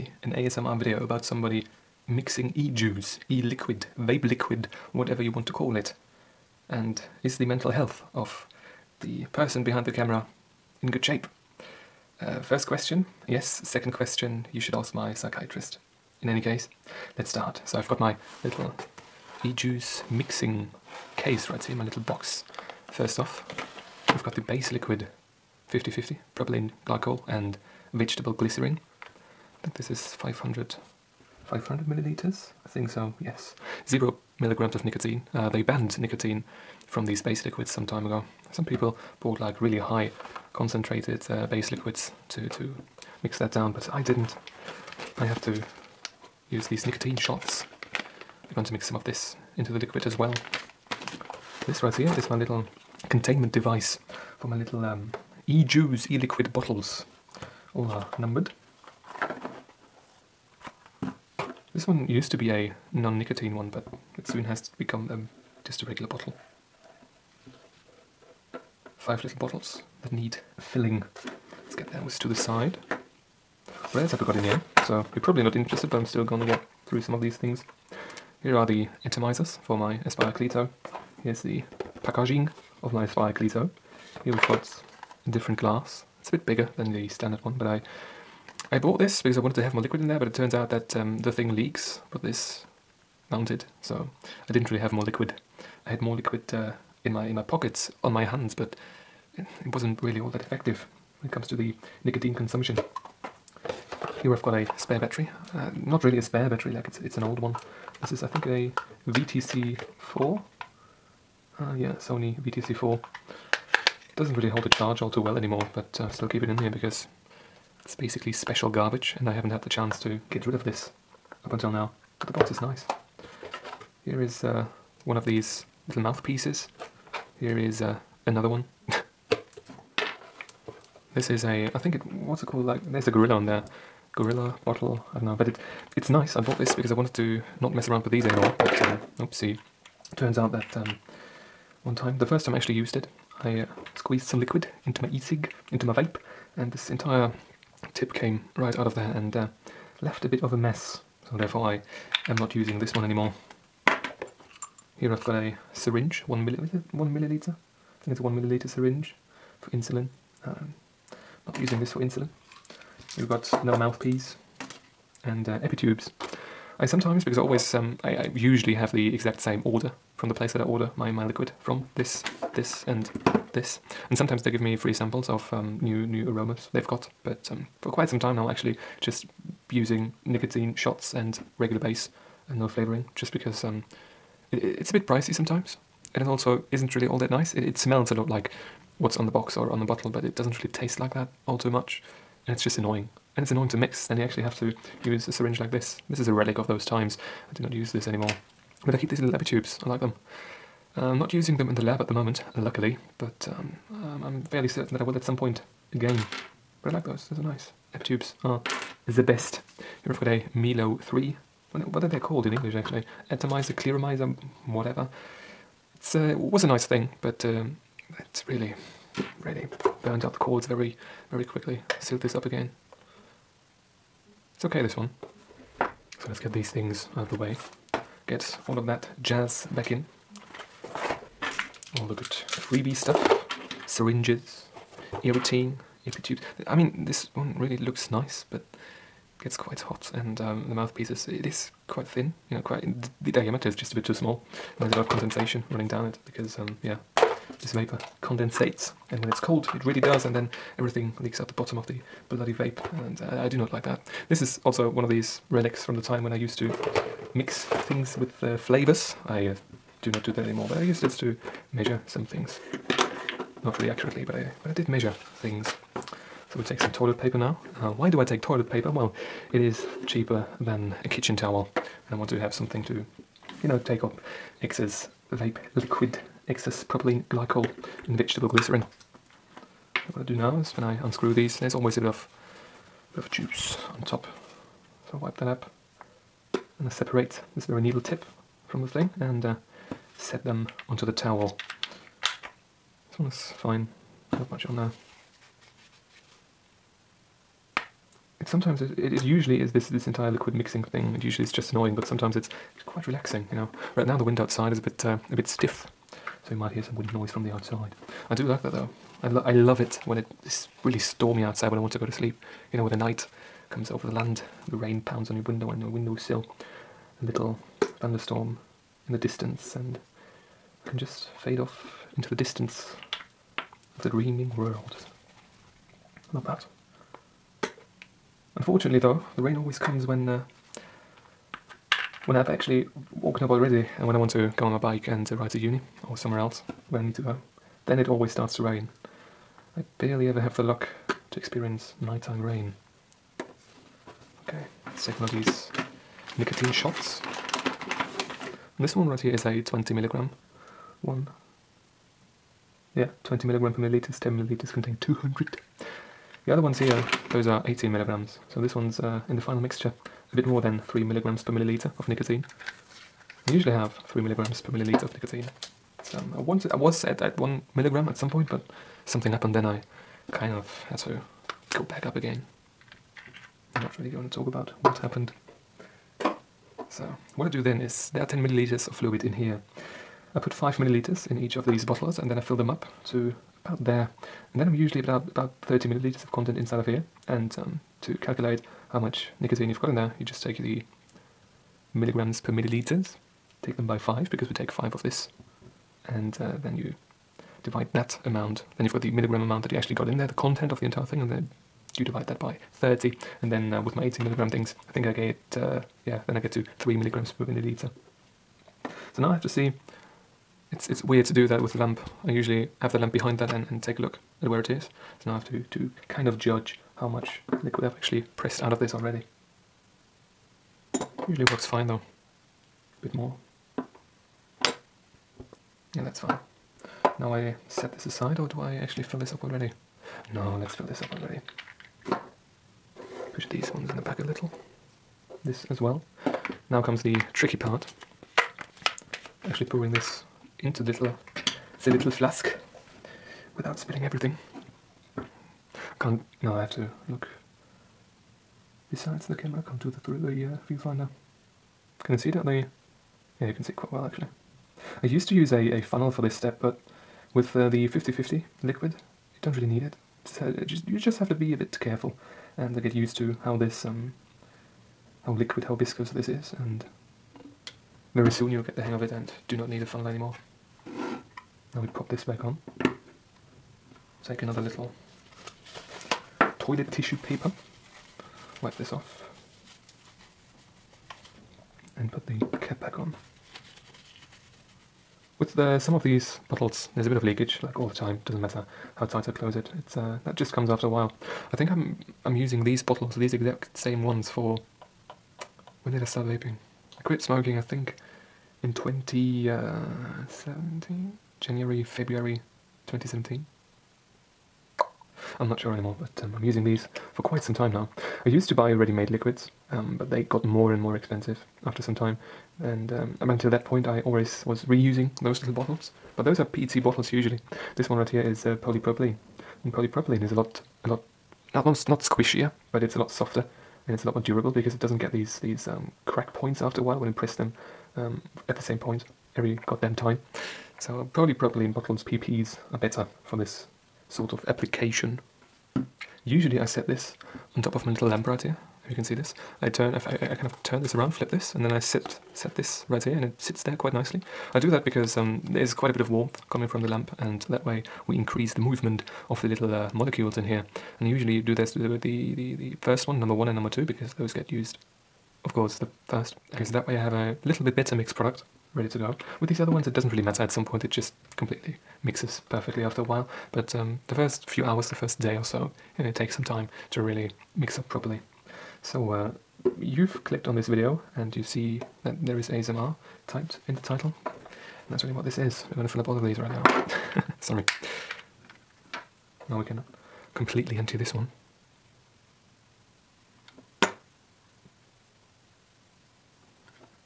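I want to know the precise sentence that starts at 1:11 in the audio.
Let's get those to the side.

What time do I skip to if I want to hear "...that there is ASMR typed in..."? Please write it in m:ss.
9:32.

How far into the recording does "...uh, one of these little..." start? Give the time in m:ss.
2:04.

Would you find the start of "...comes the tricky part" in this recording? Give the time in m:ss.
7:16.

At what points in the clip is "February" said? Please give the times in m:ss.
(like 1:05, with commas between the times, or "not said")
8:21.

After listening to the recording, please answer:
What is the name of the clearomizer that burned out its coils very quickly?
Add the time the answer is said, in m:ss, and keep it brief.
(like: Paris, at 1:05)
Melo 3, at 3:30.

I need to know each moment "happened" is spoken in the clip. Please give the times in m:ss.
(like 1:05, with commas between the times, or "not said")
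6:09, 6:14.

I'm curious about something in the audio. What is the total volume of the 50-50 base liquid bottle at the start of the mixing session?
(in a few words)
500 milliliters.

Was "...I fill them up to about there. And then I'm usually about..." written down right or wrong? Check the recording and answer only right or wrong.
right.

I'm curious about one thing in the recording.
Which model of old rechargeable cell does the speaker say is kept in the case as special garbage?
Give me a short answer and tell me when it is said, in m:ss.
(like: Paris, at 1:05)
Sony VTC4, at 1:51.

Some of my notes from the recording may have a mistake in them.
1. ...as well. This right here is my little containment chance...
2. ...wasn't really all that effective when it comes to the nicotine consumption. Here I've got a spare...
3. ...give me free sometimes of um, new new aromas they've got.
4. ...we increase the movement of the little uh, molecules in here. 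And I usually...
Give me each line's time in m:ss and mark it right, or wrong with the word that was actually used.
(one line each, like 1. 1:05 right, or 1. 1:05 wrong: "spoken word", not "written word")
1. 0:50 wrong: "device", not "chance"
2. 1:39 right
3. 2:54 wrong: "samples", not "sometimes"
4. 9:08 right.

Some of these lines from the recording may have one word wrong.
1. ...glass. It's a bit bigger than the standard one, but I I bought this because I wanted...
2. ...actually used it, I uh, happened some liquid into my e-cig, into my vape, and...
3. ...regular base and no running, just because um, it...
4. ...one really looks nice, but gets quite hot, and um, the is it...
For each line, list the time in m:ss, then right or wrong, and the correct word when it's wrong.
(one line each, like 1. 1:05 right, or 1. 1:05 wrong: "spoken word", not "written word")
1. 1:25 right
2. 2:22 wrong: "squeezed", not "happened"
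3. 3:01 wrong: "flavoring", not "running"
4. 3:57 right.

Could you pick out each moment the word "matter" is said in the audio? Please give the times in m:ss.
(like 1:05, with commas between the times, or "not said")
8:08, 9:20.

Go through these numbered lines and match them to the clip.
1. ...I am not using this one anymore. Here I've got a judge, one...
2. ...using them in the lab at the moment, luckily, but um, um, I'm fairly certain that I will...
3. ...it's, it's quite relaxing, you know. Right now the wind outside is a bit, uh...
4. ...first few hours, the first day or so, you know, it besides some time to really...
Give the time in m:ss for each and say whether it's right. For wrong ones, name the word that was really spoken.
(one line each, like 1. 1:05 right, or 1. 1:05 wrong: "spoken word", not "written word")
1. 2:31 wrong: "syringe", not "judge"
2. 3:21 right
3. 5:02 right
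4. 9:24 wrong: "takes", not "besides".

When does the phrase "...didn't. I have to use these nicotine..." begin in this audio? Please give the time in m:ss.
0:44.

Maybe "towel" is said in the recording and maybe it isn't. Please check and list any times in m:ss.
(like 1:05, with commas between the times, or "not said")
4:31, 4:51.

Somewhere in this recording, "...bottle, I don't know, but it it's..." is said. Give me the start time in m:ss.
2:14.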